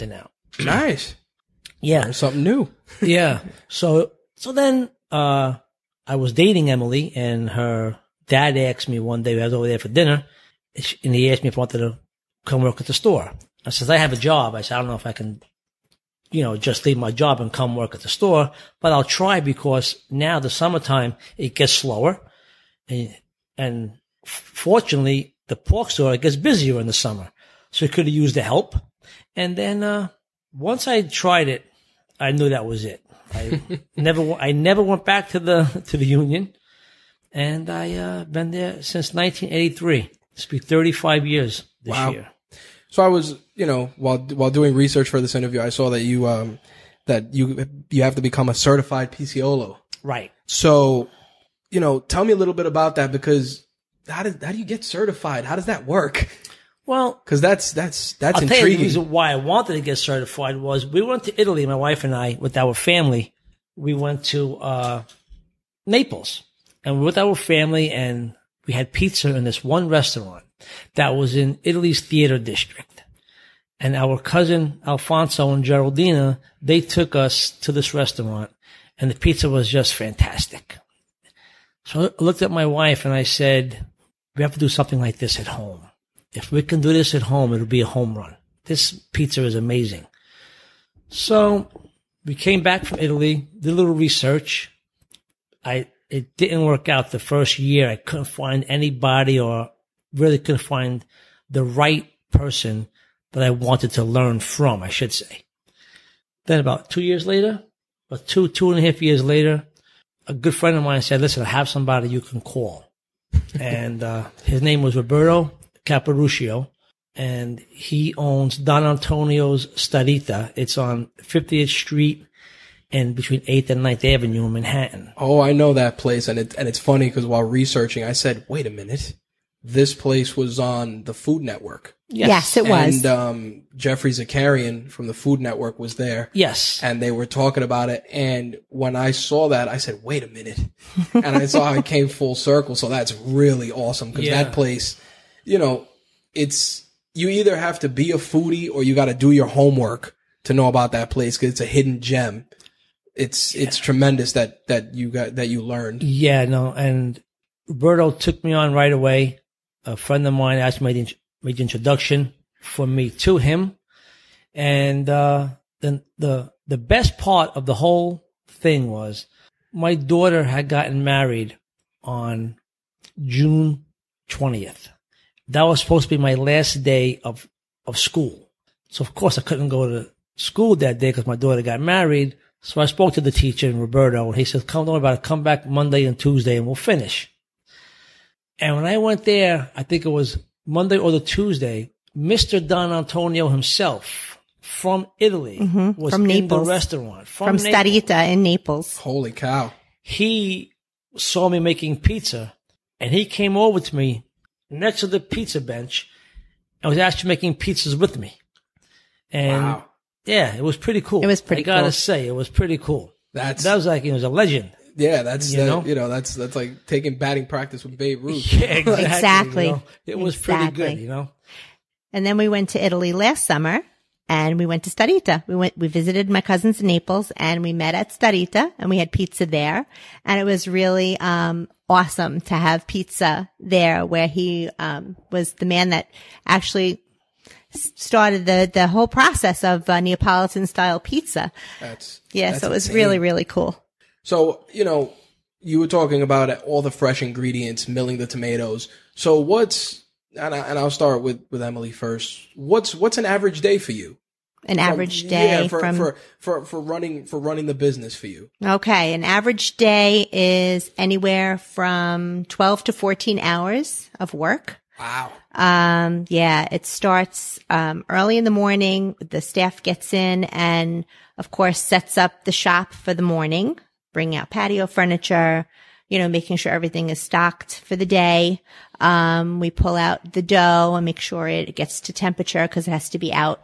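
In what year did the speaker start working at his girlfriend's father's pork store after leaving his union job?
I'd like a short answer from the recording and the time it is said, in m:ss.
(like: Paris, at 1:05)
1983, at 0:39.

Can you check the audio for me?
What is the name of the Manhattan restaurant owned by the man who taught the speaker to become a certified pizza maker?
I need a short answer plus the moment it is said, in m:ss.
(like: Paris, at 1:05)
Don Antonio's Starita, at 1:58.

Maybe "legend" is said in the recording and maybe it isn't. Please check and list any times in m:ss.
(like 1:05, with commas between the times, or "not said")
3:34.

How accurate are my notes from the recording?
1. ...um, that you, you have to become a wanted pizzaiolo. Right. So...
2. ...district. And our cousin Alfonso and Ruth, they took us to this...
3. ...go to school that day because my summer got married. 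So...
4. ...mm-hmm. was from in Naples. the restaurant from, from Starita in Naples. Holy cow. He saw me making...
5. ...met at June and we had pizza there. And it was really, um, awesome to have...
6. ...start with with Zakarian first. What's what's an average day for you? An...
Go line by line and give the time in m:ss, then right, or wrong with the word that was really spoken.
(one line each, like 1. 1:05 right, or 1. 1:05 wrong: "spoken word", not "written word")
1. 0:46 wrong: "certified", not "wanted"
2. 1:12 wrong: "Geraldina", not "Ruth"
3. 2:59 wrong: "daughter", not "summer"
4. 3:15 right
5. 3:47 wrong: "Starita", not "June"
6. 4:10 wrong: "Emily", not "Zakarian".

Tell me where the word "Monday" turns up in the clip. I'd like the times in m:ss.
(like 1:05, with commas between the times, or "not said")
3:05, 3:10.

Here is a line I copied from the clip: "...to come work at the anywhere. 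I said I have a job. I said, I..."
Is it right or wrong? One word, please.
wrong.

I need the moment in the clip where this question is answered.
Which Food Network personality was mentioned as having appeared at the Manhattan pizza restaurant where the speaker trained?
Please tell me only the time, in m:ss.
2:13.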